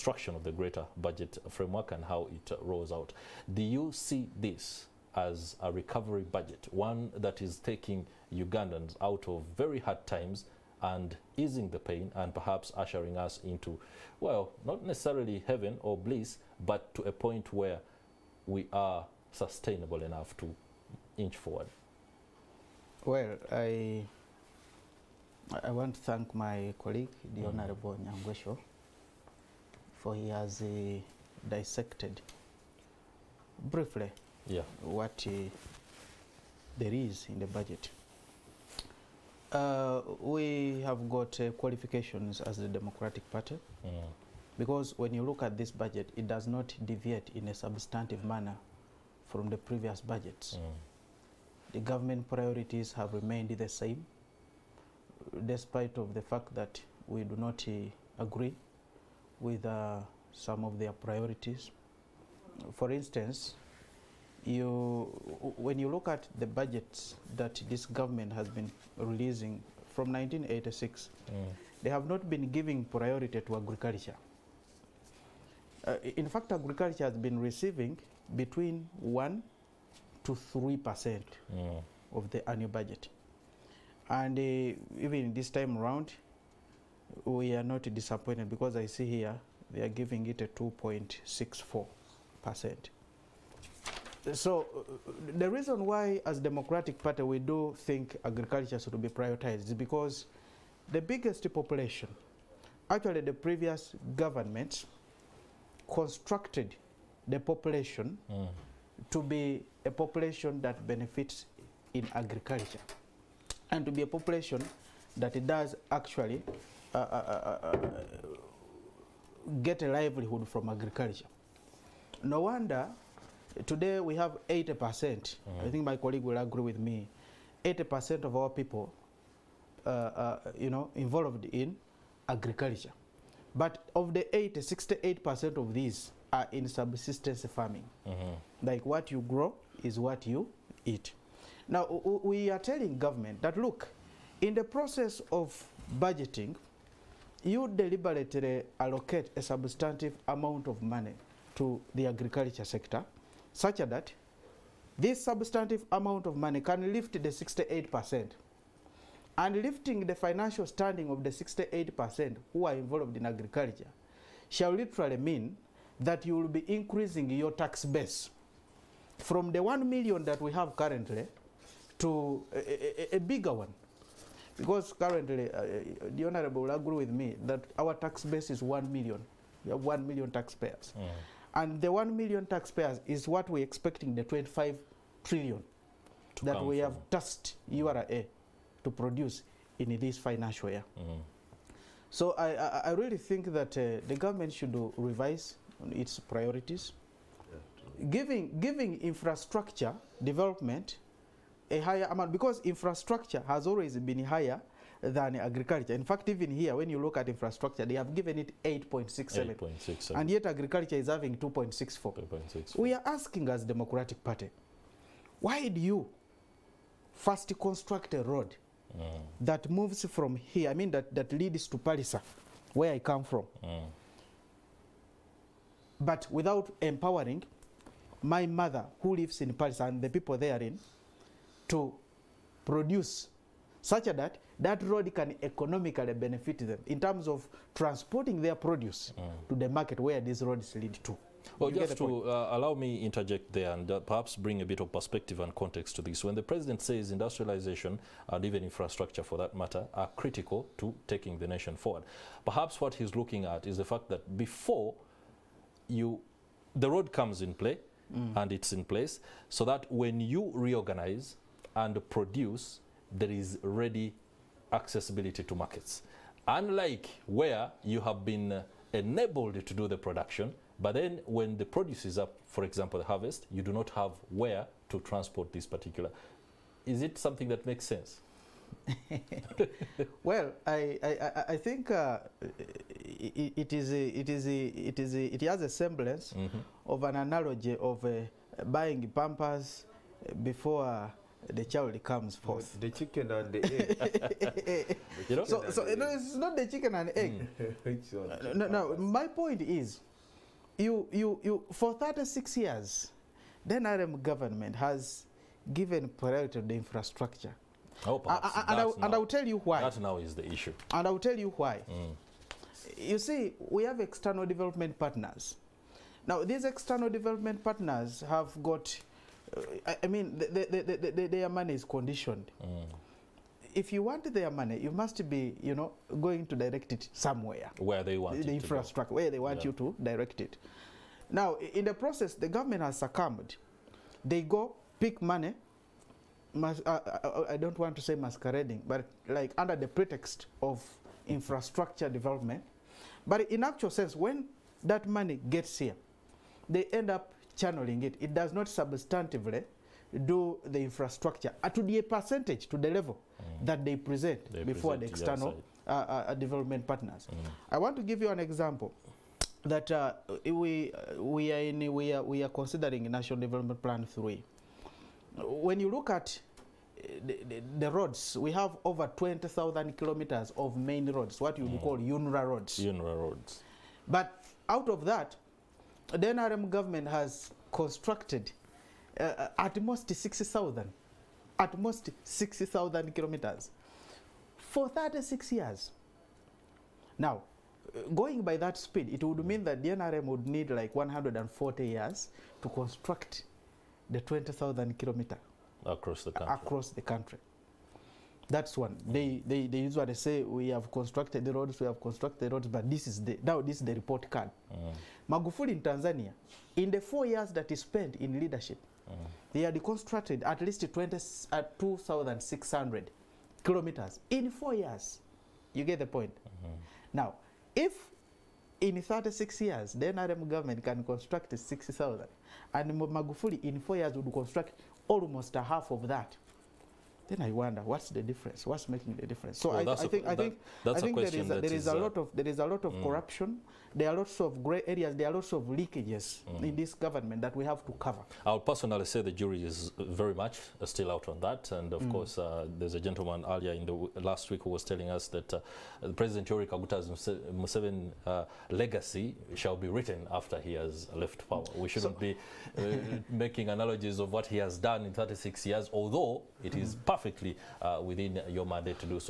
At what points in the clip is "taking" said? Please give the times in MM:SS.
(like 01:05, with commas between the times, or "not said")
00:07, 04:11.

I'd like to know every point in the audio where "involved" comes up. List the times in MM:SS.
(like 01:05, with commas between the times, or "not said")
02:10, 02:42.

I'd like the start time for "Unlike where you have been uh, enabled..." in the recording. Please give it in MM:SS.
04:26.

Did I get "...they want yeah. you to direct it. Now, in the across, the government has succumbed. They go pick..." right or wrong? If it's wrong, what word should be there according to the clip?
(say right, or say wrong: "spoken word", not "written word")
wrong: "process", not "across".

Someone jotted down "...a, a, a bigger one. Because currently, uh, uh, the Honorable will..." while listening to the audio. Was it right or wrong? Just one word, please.
right.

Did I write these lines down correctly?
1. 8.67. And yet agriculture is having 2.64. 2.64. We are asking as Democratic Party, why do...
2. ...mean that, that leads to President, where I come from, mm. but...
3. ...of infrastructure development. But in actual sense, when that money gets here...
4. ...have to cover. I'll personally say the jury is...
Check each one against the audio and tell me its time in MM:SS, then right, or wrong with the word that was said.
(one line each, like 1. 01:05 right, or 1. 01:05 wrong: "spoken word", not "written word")
1. 03:29 right
2. 03:40 wrong: "Pallisa", not "President"
3. 05:40 right
4. 07:17 right.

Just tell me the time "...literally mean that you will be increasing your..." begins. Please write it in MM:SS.
02:44.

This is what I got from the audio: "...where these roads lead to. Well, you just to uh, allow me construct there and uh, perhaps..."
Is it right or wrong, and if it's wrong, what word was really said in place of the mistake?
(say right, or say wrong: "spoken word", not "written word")
wrong: "interject", not "construct".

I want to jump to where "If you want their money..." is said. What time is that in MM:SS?
05:23.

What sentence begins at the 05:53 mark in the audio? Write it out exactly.
that they present they before present the external uh, uh, uh, development partners.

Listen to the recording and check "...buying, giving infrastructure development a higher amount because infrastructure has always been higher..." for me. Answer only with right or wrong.
wrong.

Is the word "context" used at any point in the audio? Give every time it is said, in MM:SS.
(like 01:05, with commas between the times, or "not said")
04:05.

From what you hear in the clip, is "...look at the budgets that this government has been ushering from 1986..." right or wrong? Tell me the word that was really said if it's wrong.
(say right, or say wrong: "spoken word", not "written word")
wrong: "releasing", not "ushering".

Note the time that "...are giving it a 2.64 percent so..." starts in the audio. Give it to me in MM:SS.
01:29.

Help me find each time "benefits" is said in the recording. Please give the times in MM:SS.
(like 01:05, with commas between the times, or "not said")
01:50, 03:56.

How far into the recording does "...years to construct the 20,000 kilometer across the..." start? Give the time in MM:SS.
06:31.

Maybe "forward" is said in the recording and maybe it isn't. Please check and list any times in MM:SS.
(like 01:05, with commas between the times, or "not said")
00:21, 04:11.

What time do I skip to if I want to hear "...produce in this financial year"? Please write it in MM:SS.
03:08.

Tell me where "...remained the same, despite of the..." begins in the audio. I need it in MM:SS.
00:53.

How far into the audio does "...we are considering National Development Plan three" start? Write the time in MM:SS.
06:02.